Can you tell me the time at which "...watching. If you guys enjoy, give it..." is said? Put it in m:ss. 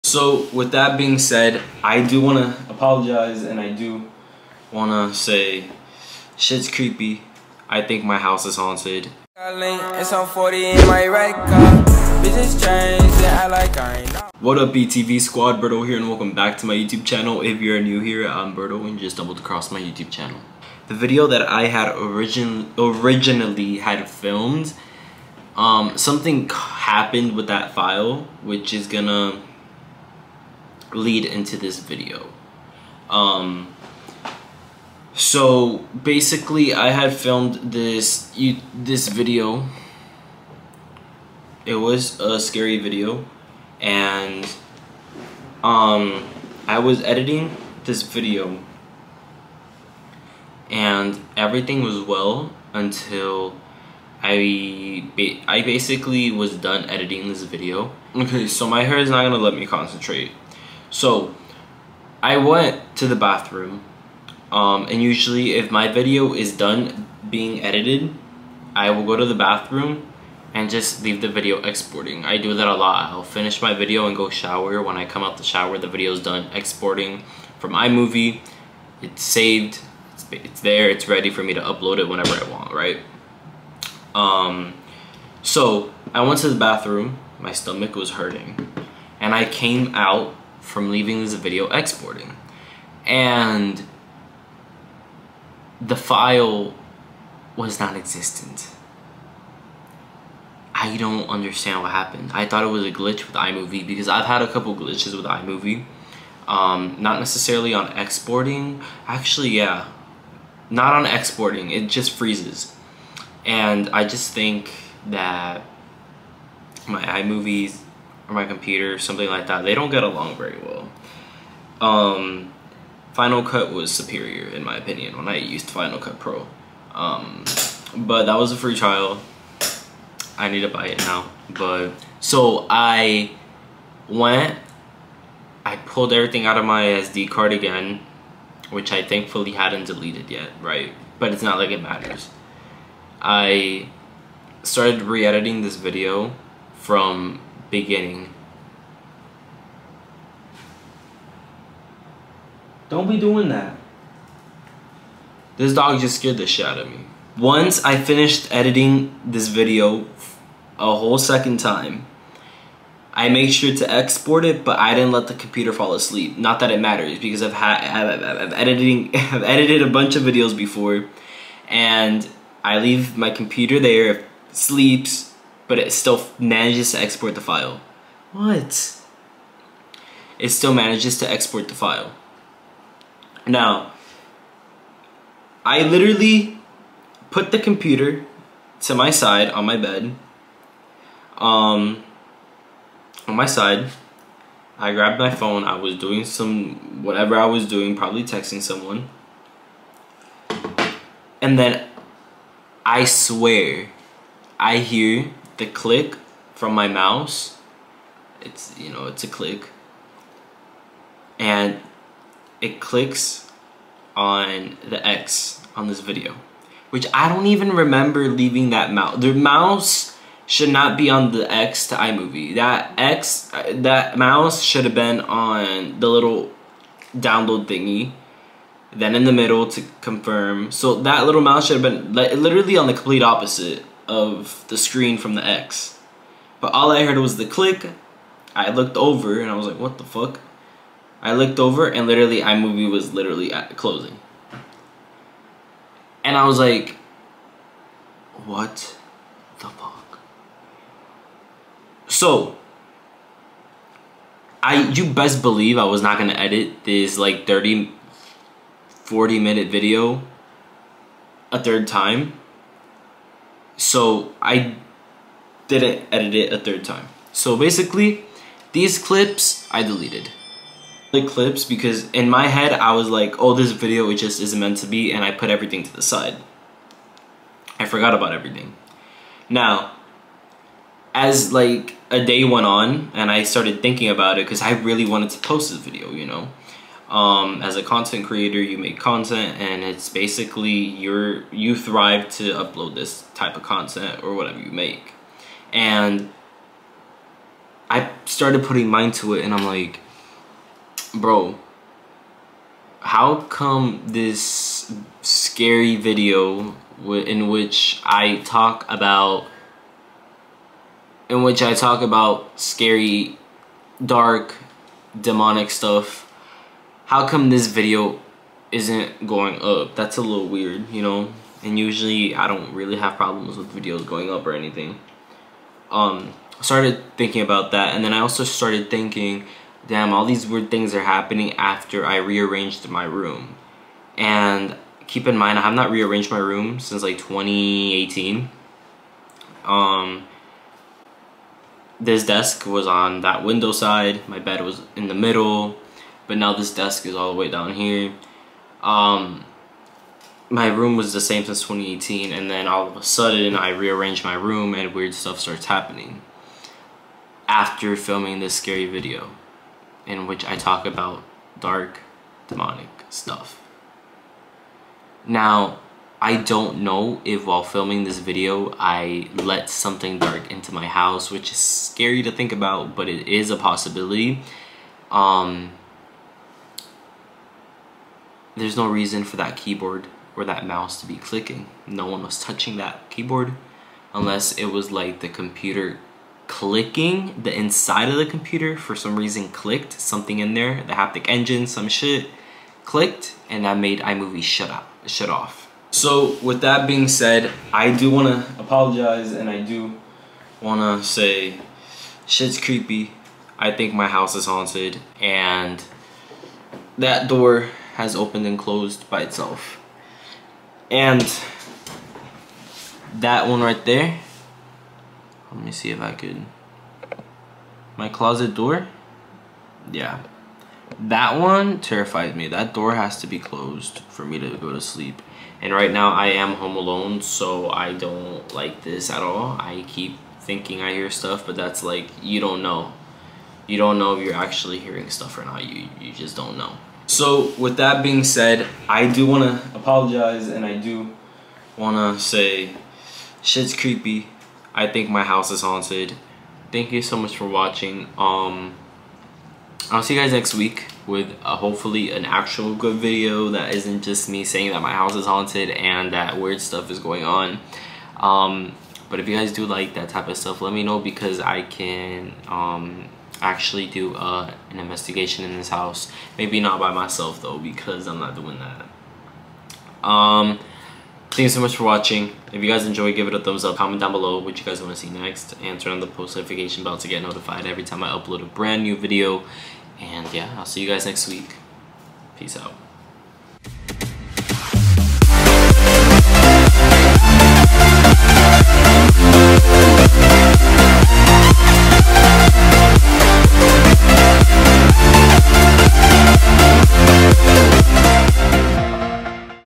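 7:51.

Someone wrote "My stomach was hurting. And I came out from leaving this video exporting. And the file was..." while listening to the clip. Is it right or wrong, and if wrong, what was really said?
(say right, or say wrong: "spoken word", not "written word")
right.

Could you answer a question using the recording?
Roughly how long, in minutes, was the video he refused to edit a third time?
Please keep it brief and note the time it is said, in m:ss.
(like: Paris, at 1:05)
30-40 minutes, at 4:17.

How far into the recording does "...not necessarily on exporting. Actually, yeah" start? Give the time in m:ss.
1:46.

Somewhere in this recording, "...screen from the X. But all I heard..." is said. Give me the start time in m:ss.
3:54.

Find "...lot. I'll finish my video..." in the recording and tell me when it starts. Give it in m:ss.
1:12.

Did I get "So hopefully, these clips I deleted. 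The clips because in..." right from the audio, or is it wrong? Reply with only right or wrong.
wrong.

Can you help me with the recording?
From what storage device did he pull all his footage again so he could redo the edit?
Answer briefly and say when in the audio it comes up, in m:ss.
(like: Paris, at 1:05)
SD card, at 2:16.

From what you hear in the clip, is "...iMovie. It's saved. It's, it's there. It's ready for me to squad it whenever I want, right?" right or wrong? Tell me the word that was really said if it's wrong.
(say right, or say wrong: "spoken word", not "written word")
wrong: "upload", not "squad".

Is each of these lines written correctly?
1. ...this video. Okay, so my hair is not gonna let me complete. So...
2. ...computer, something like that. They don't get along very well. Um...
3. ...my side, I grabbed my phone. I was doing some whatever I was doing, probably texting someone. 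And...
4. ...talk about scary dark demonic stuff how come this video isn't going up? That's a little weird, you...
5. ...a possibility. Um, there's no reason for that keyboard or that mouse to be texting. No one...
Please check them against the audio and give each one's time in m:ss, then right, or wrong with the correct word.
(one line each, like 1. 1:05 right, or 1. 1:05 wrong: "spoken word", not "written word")
1. 0:57 wrong: "concentrate", not "complete"
2. 1:58 right
3. 3:13 right
4. 5:11 right
5. 6:13 wrong: "clicking", not "texting".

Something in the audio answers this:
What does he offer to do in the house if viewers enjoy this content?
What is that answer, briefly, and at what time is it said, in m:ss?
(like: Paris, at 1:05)
An investigation, at 7:44.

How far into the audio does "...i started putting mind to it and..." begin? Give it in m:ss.
4:57.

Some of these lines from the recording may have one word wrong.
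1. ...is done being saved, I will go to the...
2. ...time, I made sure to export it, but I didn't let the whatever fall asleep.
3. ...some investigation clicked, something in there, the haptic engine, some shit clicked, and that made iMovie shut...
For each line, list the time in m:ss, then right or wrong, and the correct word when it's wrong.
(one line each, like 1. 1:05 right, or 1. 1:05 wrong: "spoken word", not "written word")
1. 1:06 wrong: "edited", not "saved"
2. 2:41 wrong: "computer", not "whatever"
3. 6:28 wrong: "reason", not "investigation".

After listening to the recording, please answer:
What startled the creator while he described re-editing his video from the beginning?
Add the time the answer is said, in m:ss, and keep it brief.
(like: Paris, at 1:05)
Dog, at 2:35.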